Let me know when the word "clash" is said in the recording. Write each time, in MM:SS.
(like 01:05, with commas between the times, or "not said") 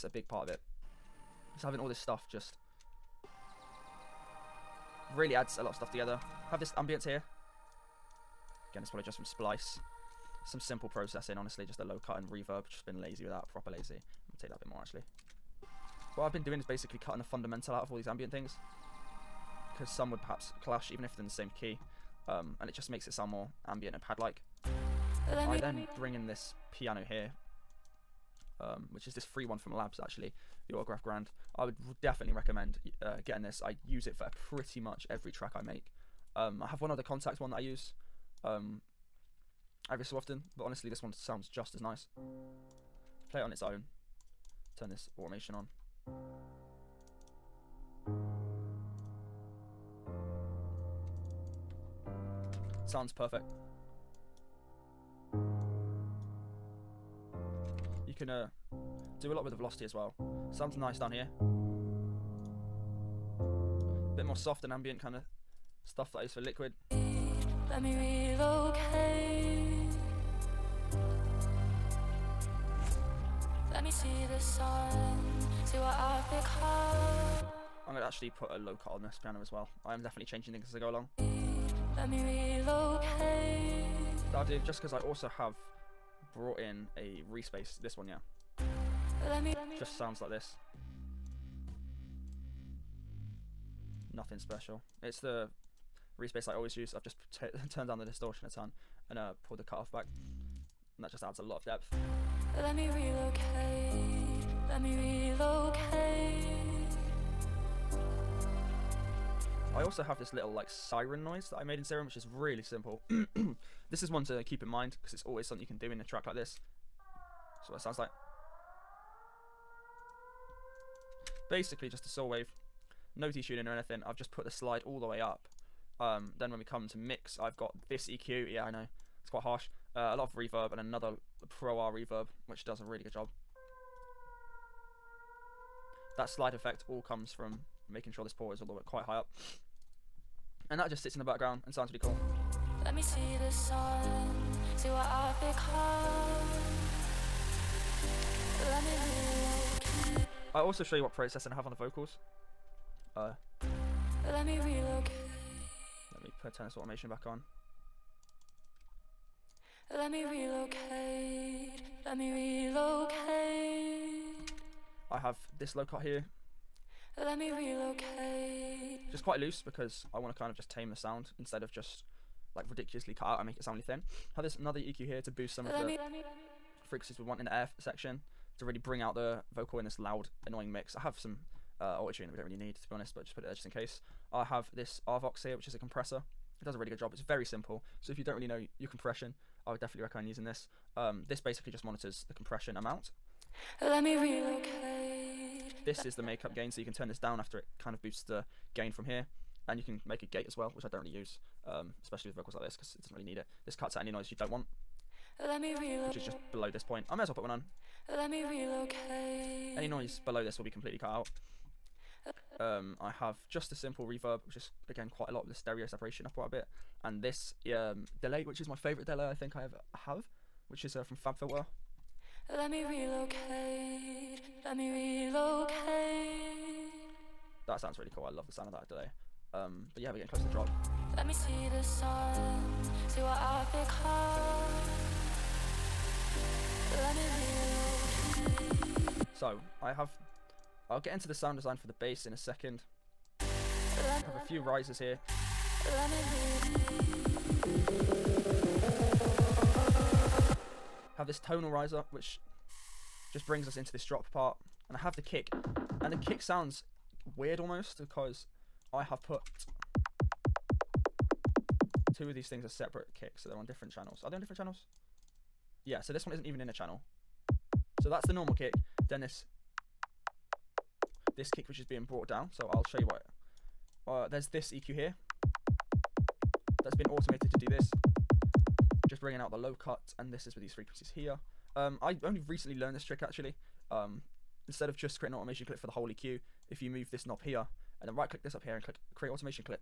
00:20.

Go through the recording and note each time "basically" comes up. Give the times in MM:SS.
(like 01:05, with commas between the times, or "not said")
00:16, 02:01, 03:11.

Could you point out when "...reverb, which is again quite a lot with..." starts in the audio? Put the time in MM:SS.
03:34.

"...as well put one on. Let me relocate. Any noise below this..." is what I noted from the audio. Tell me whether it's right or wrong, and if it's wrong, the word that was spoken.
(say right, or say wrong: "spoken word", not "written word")
right.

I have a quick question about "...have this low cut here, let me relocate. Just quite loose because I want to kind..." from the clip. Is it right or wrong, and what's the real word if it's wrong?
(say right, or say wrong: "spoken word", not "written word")
right.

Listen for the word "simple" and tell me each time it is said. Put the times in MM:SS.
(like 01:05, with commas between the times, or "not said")
00:10, 01:52, 03:07, 03:33.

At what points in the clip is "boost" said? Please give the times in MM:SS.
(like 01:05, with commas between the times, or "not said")
02:55, 03:18.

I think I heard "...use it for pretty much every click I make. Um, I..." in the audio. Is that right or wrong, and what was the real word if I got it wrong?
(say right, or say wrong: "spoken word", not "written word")
wrong: "track", not "click".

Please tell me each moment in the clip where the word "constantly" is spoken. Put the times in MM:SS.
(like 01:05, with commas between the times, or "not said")
not said.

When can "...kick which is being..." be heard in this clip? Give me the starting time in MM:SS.
04:31.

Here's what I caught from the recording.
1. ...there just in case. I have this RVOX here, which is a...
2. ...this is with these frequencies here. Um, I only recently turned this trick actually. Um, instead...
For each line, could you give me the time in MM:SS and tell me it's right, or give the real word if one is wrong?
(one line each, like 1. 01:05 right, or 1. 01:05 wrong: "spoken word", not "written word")
1. 03:03 right
2. 04:40 wrong: "learned", not "turned".